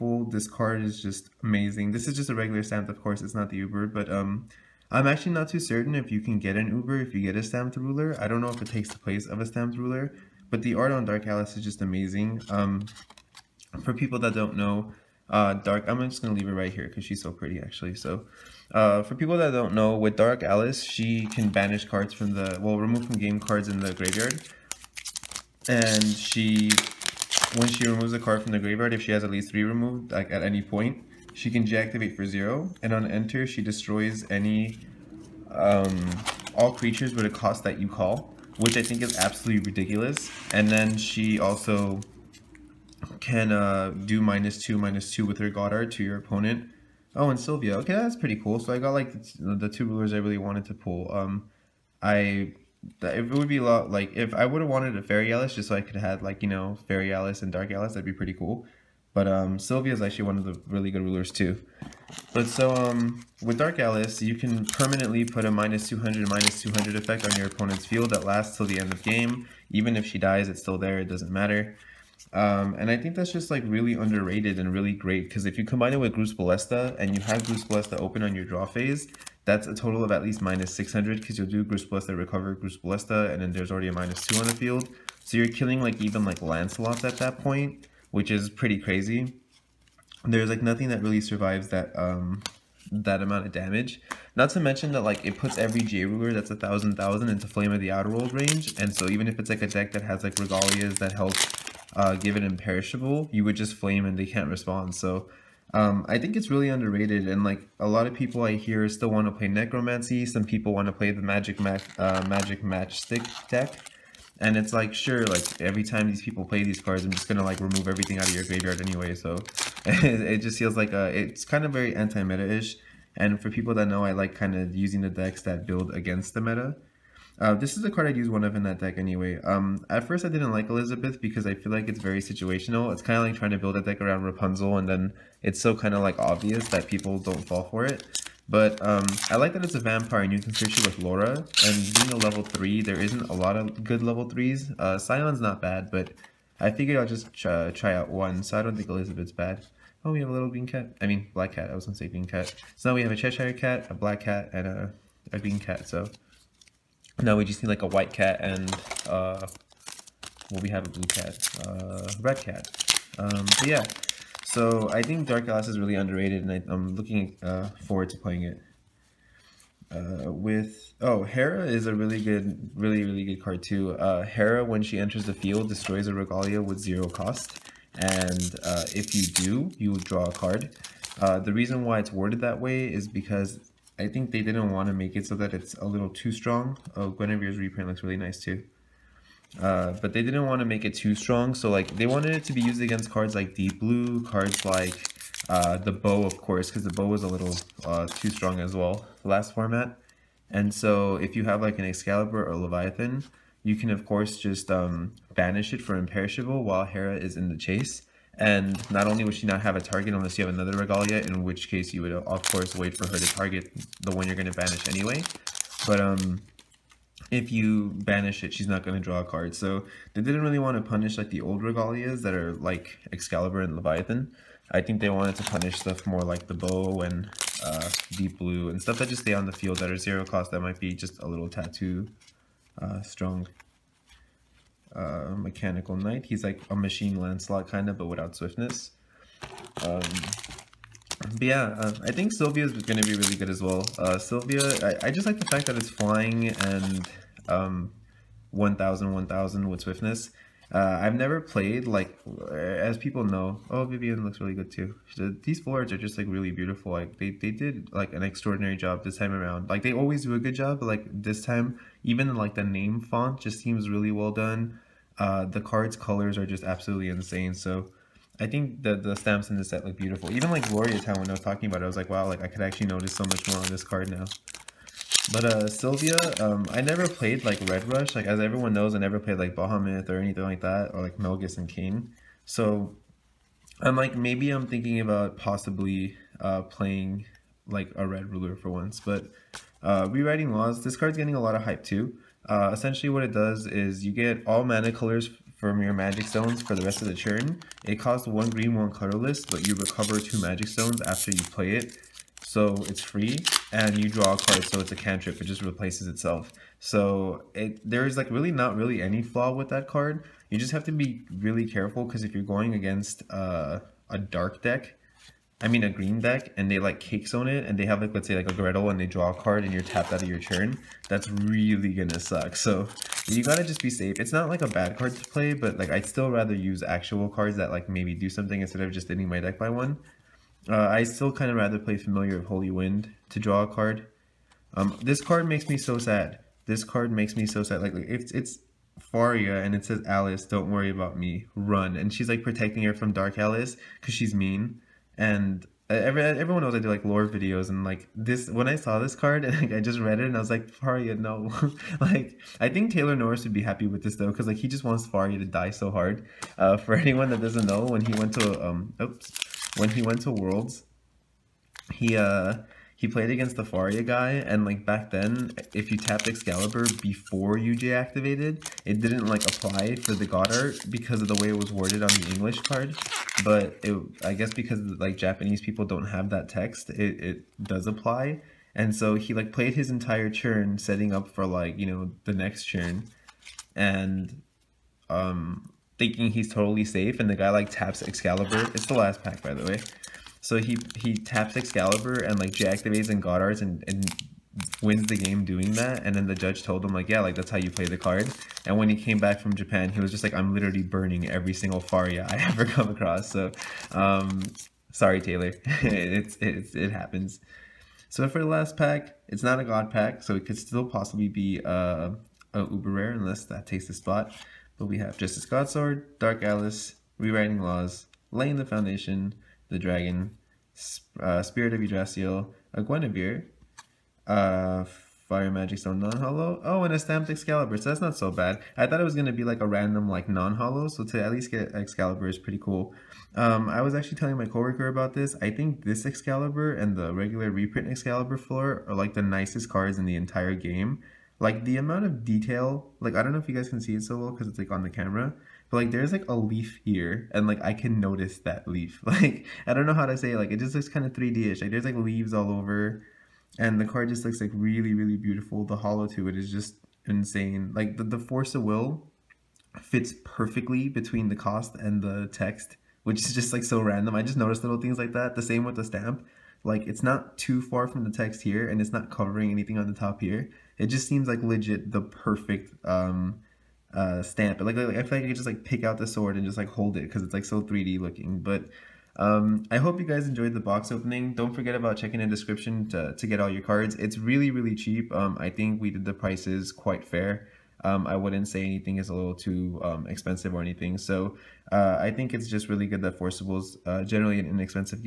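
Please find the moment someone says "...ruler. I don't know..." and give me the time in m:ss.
0:07.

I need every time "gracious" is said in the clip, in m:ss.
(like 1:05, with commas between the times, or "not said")
not said.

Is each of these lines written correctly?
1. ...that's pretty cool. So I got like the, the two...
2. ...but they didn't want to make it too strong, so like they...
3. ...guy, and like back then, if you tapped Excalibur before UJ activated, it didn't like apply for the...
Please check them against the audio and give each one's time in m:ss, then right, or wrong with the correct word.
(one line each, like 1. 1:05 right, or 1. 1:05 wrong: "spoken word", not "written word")
1. 0:47 right
2. 3:10 right
3. 6:04 right.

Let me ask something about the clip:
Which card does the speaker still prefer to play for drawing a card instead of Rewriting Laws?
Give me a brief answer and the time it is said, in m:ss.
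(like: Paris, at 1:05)
Familiar of Holy Wind, at 5:31.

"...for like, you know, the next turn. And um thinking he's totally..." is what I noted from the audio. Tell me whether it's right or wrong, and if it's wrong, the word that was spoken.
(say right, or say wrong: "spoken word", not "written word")
right.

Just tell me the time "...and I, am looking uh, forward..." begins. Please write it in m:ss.
2:46.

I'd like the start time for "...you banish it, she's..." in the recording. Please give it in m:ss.
3:37.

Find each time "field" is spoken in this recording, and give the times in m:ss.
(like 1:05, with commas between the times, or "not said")
1:07, 1:24, 2:55, 3:49.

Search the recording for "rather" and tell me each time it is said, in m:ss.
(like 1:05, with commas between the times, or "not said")
5:26, 5:31.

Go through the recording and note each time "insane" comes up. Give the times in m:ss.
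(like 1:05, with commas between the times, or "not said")
4:27, 7:37.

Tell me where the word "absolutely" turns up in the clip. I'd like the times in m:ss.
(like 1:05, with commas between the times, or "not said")
0:39, 4:26.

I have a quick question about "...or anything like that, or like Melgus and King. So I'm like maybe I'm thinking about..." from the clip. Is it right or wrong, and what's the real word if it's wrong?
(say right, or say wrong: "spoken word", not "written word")
right.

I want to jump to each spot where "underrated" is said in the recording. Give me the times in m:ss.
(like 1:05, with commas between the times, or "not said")
1:13, 1:46, 2:45.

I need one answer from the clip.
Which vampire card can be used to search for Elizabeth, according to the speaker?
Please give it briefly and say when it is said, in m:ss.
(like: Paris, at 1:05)
Laura, at 2:20.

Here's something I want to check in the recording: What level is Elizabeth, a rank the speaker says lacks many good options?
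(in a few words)
3.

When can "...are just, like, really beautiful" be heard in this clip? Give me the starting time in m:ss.
4:15.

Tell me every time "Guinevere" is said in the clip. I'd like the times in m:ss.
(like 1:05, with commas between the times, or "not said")
3:07, 7:02.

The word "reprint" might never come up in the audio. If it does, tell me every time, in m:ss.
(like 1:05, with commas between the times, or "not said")
3:07, 7:17.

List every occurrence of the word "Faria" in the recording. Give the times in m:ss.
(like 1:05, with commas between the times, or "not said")
5:38, 5:50, 5:55, 6:03, 6:41.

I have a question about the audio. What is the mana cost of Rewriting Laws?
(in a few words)
one green, one colorless.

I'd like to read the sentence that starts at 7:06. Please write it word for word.
Oh, and a stamped Excalibur, so that's not so bad.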